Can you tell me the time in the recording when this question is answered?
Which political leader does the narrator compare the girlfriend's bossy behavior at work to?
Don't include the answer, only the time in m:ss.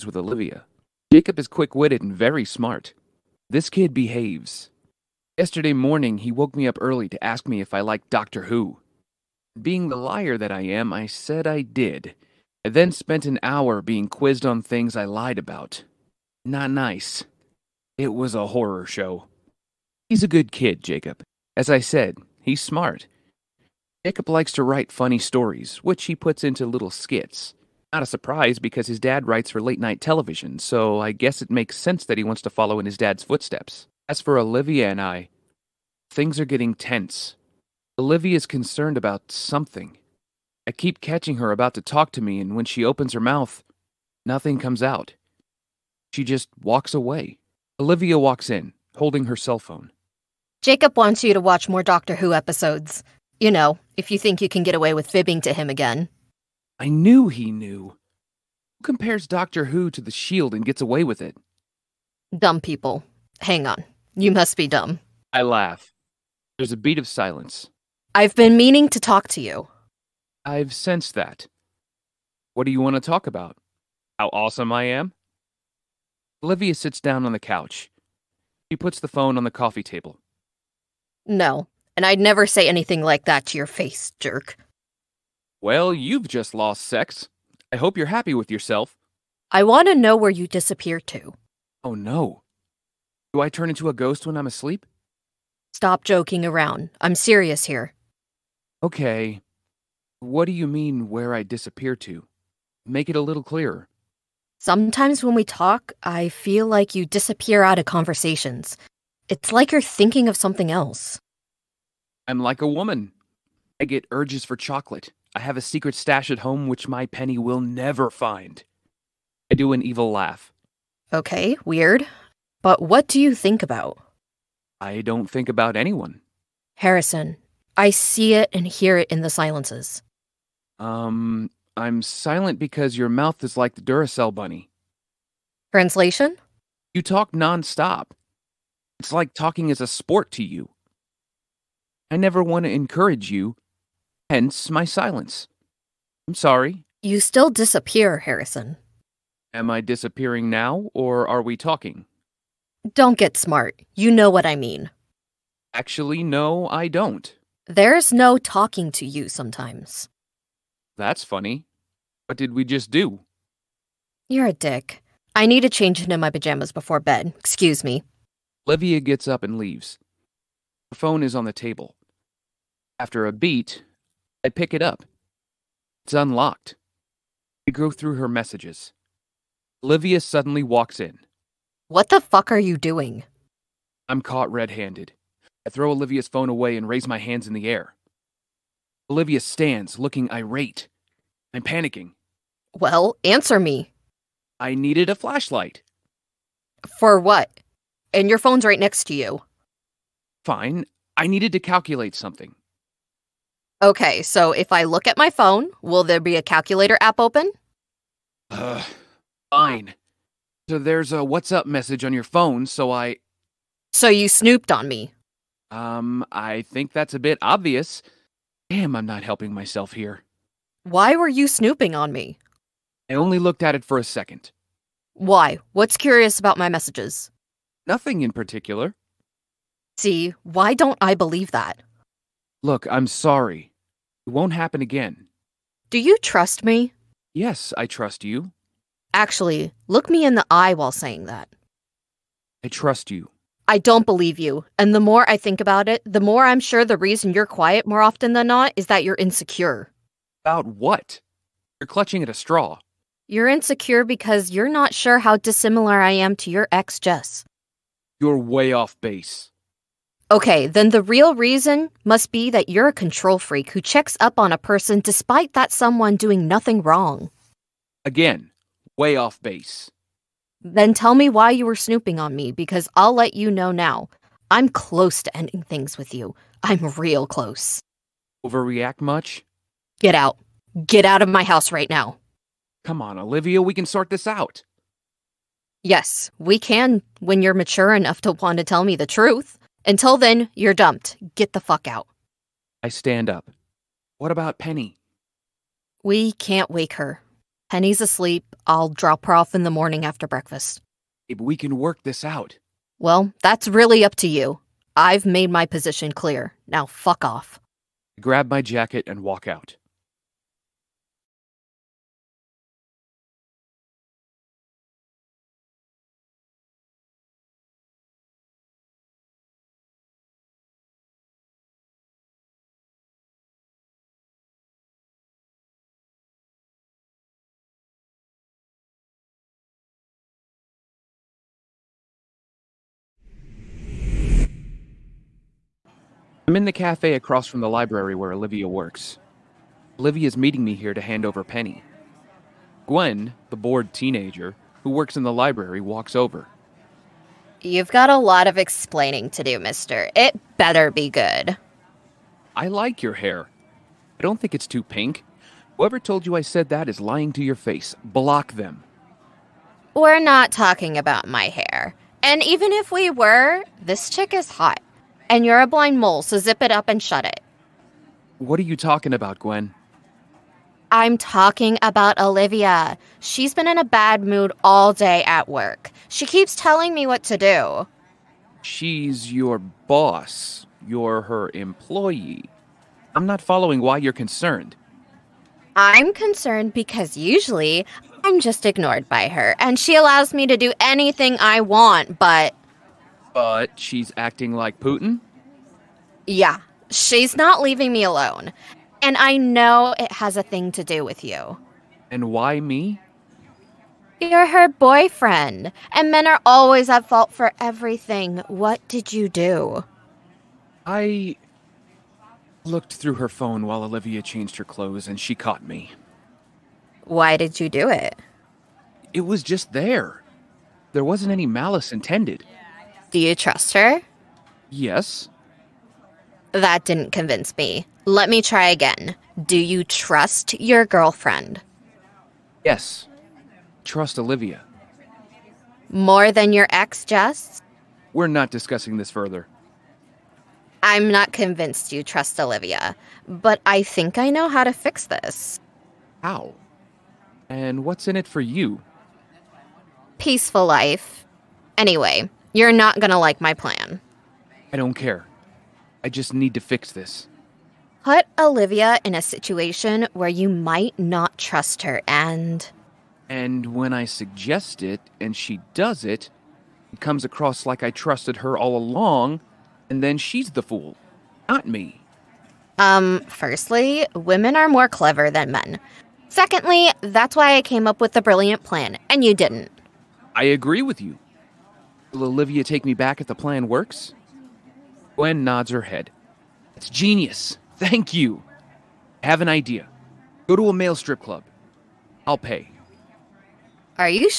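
6:34.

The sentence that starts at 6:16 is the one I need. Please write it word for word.
She keeps telling me what to do.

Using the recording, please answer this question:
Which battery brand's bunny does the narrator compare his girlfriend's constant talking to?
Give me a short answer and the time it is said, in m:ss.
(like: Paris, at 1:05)
Duracell, at 2:13.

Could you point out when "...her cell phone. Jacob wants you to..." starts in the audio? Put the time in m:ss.
0:49.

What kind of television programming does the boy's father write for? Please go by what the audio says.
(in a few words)
late night television.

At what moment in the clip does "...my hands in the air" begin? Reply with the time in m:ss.
3:07.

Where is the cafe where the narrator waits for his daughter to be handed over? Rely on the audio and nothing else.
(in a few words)
across from the library.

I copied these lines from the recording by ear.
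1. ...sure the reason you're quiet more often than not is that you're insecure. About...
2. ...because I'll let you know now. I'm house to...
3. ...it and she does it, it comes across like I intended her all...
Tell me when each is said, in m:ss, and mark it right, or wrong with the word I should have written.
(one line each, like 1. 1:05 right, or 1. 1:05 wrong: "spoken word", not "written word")
1. 4:06 right
2. 4:32 wrong: "close", not "house"
3. 7:44 wrong: "trusted", not "intended".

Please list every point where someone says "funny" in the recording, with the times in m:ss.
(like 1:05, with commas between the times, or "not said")
0:24, 2:41.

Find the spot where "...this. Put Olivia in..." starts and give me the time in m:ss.
7:36.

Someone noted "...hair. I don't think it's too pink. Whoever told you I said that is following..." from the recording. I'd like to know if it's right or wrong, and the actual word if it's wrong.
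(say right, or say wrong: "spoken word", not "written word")
wrong: "lying", not "following".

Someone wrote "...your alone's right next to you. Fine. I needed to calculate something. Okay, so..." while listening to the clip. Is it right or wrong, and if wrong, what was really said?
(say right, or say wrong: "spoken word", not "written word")
wrong: "phone", not "alone".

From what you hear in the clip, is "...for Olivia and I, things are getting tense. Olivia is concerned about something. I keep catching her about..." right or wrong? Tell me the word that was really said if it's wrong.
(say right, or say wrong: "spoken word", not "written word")
right.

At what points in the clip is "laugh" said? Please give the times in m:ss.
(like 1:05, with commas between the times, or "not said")
1:05, 2:00.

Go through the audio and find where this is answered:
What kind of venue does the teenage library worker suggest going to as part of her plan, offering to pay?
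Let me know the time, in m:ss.
8:10.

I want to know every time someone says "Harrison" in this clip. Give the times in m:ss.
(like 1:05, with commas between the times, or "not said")
2:06, 2:28.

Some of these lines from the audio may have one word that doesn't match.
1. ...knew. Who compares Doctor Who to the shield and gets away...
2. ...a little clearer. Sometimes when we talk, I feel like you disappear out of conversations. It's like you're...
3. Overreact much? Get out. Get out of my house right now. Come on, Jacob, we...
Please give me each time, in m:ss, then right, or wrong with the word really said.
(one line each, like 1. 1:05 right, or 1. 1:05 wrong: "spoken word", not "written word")
1. 0:57 right
2. 1:43 right
3. 4:38 wrong: "Olivia", not "Jacob".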